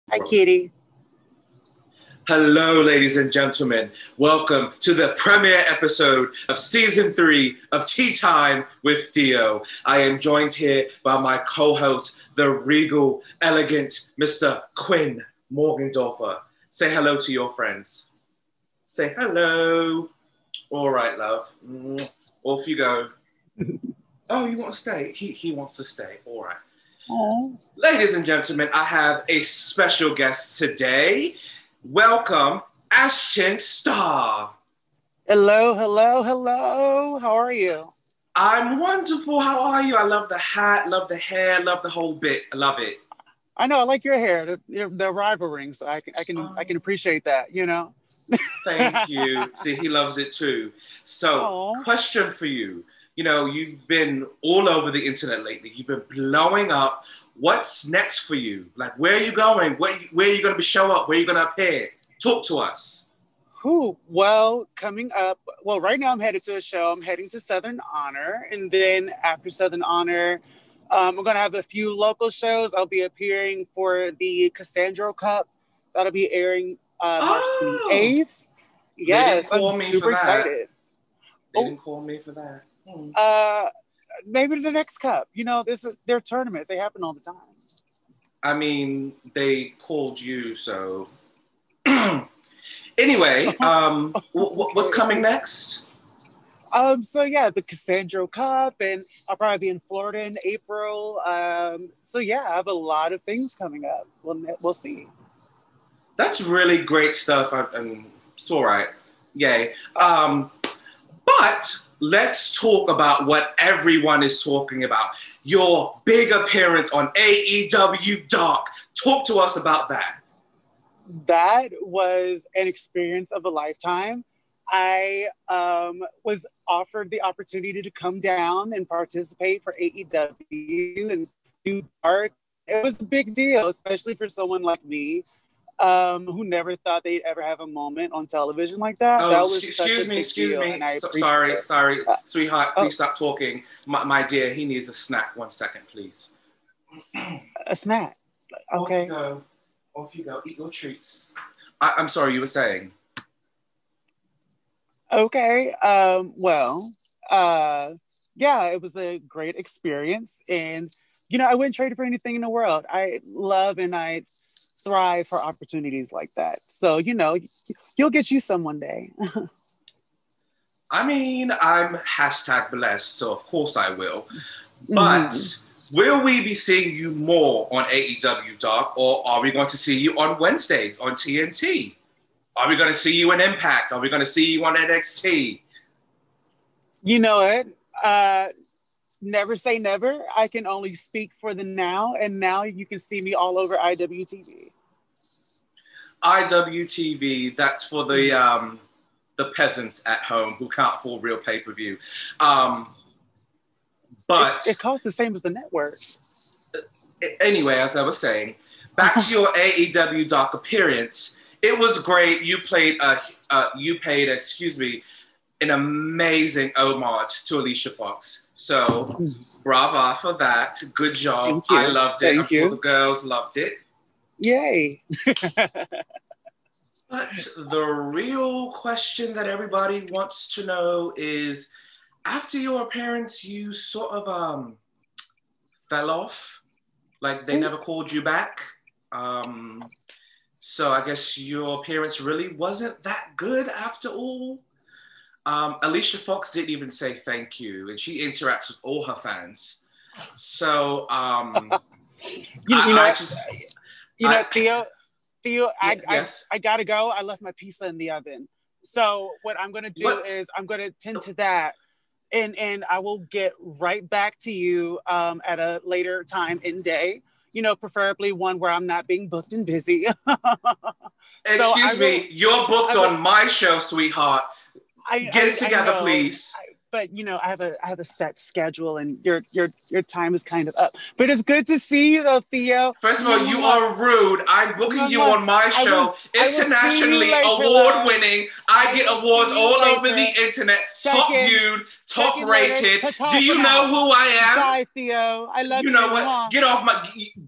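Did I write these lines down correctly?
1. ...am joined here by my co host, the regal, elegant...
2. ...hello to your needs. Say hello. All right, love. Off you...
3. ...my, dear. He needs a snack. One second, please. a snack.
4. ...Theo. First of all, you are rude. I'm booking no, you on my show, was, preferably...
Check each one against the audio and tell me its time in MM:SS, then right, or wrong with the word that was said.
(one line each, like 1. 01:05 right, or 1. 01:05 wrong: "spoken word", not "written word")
1. 00:09 right
2. 00:16 wrong: "friends", not "needs"
3. 02:24 right
4. 04:42 wrong: "internationally", not "preferably".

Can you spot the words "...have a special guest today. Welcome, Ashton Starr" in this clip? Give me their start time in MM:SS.
00:28.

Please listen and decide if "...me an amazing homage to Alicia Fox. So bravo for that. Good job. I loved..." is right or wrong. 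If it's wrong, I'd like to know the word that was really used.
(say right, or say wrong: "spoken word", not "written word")
right.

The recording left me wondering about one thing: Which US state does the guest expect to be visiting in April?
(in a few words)
Florida.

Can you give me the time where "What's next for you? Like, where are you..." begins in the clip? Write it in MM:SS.
00:57.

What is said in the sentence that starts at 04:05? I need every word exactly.
Um, Alicia Fox didn't even say thank you, and she interacts with all her fans.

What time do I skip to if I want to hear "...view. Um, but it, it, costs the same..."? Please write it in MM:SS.
03:21.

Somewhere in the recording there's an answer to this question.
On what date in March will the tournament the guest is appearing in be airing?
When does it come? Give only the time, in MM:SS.
01:17.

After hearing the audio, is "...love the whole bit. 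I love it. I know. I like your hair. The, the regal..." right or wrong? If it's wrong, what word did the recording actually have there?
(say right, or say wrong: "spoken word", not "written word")
wrong: "rival", not "regal".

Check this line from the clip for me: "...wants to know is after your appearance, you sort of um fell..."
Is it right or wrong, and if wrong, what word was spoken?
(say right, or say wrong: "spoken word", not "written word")
right.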